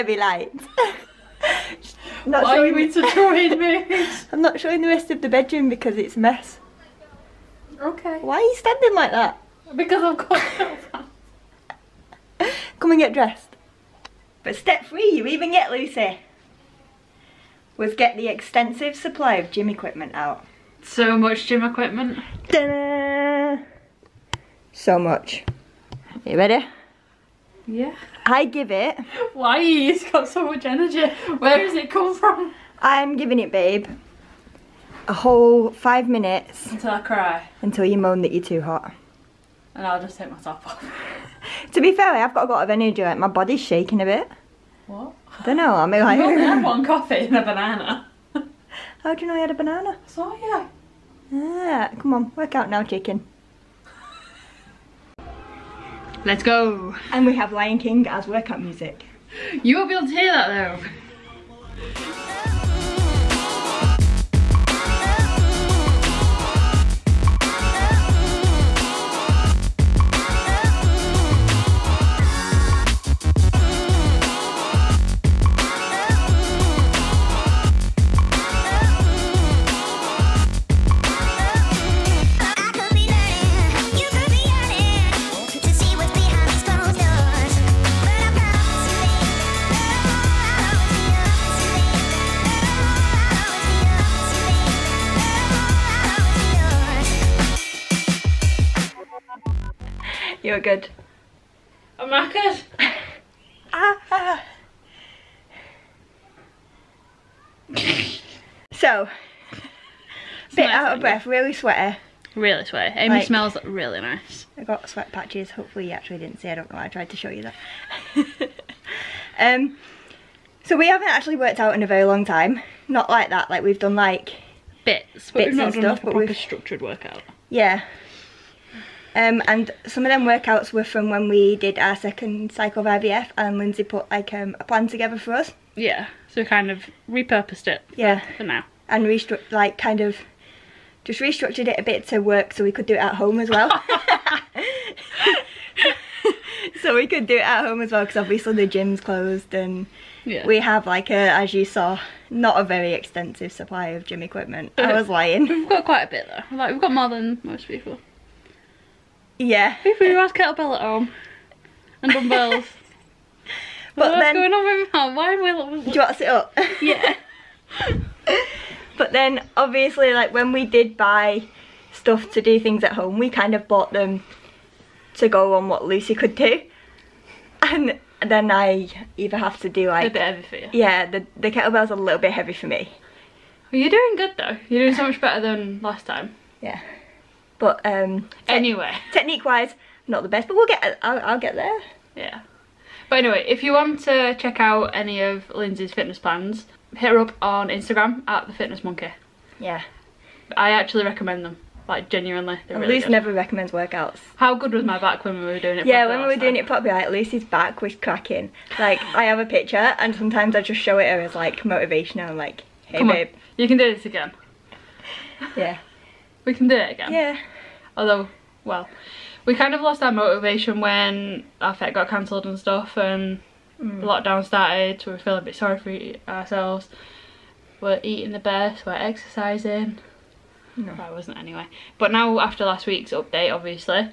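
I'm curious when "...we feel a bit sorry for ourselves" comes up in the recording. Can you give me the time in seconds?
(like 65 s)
225 s.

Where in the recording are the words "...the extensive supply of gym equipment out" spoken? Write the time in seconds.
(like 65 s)
18 s.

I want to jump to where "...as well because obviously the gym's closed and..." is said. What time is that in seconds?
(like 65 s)
147 s.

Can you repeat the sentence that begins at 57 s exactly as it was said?
And we have Lion King as workout music.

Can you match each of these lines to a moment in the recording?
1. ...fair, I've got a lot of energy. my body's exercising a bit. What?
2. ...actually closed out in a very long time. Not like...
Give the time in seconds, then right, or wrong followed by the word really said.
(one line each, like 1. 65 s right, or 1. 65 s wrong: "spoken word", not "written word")
1. 41 s wrong: "shaking", not "exercising"
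2. 121 s wrong: "worked", not "closed".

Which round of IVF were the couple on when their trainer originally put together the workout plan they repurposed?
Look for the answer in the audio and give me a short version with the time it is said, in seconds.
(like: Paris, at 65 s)
second, at 131 s.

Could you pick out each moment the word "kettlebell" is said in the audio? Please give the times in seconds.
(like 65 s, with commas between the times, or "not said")
160 s, 181 s.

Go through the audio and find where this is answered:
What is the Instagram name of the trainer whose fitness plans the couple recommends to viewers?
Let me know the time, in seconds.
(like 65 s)
198 s.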